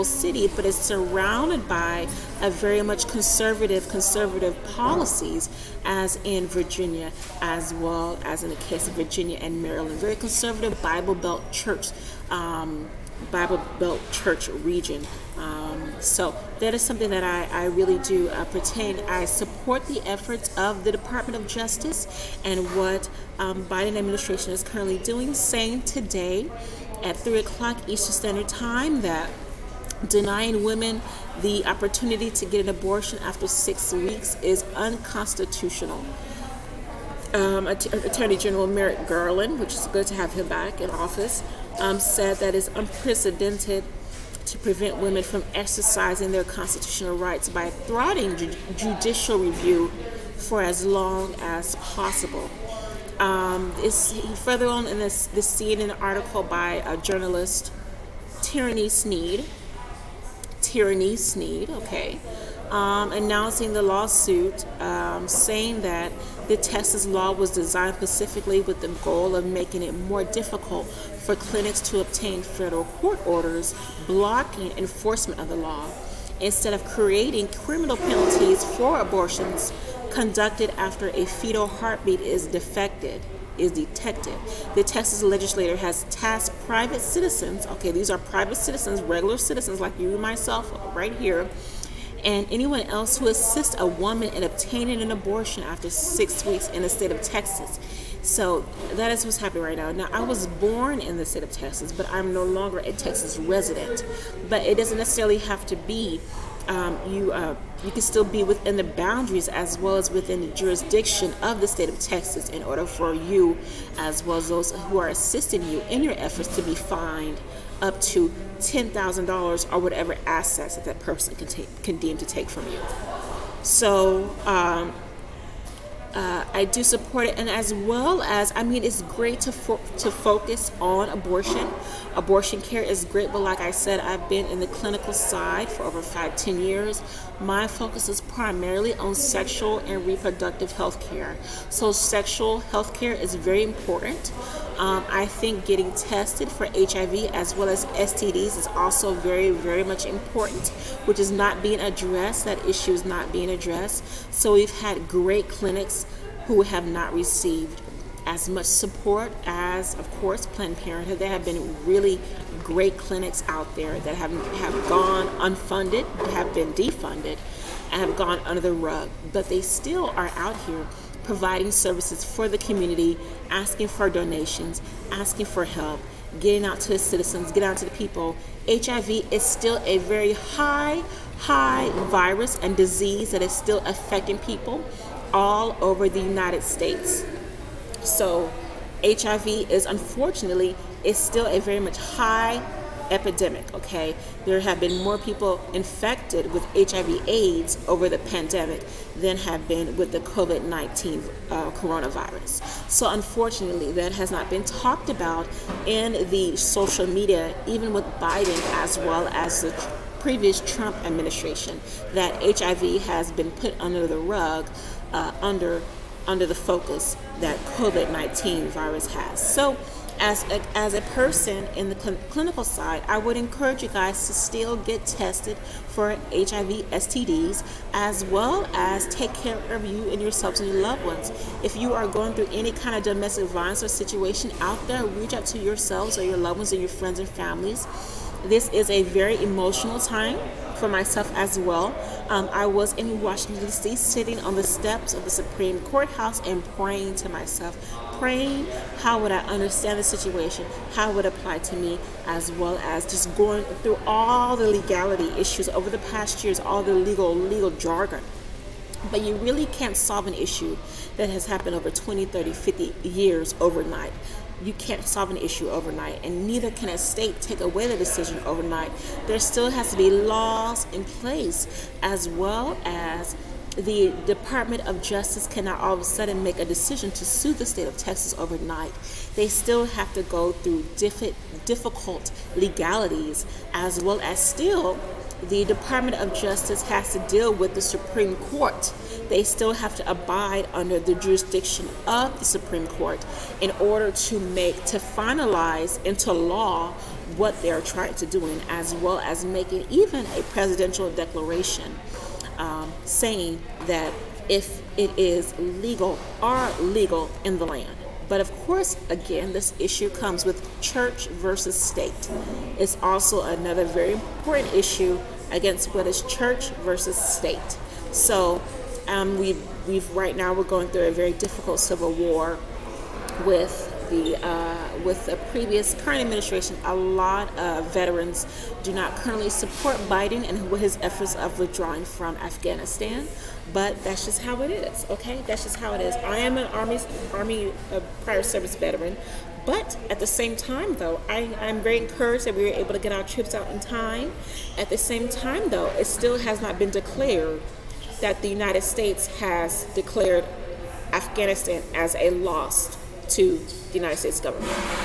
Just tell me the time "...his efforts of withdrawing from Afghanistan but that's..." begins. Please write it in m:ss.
5:30.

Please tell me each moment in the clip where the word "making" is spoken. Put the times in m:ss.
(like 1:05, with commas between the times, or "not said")
1:09, 4:59.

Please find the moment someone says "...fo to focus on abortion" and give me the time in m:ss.
2:09.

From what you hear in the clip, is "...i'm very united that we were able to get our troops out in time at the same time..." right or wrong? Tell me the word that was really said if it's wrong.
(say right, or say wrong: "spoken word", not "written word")
wrong: "encouraged", not "united".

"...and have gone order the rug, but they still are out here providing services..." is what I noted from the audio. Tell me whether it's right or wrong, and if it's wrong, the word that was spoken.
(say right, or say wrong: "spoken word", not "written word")
wrong: "under", not "order".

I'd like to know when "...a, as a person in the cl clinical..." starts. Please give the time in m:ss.
3:40.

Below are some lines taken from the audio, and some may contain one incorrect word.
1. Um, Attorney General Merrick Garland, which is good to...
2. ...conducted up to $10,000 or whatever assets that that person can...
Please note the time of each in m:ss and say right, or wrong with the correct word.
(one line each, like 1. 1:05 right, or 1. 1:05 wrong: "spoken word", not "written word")
1. 0:37 right
2. 1:56 wrong: "fined", not "conducted".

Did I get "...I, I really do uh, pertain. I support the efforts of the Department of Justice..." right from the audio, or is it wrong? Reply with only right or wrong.
right.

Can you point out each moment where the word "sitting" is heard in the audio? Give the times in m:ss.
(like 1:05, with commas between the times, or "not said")
4:03.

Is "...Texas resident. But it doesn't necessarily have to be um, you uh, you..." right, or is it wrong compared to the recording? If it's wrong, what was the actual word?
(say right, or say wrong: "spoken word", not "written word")
right.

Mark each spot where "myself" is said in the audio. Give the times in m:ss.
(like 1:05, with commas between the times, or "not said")
1:30, 4:00, 4:07.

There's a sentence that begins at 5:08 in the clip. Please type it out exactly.
But of course, again, this issue comes with church versus state.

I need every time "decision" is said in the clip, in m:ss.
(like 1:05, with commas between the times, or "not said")
4:27, 4:36.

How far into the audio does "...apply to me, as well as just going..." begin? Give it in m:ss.
4:11.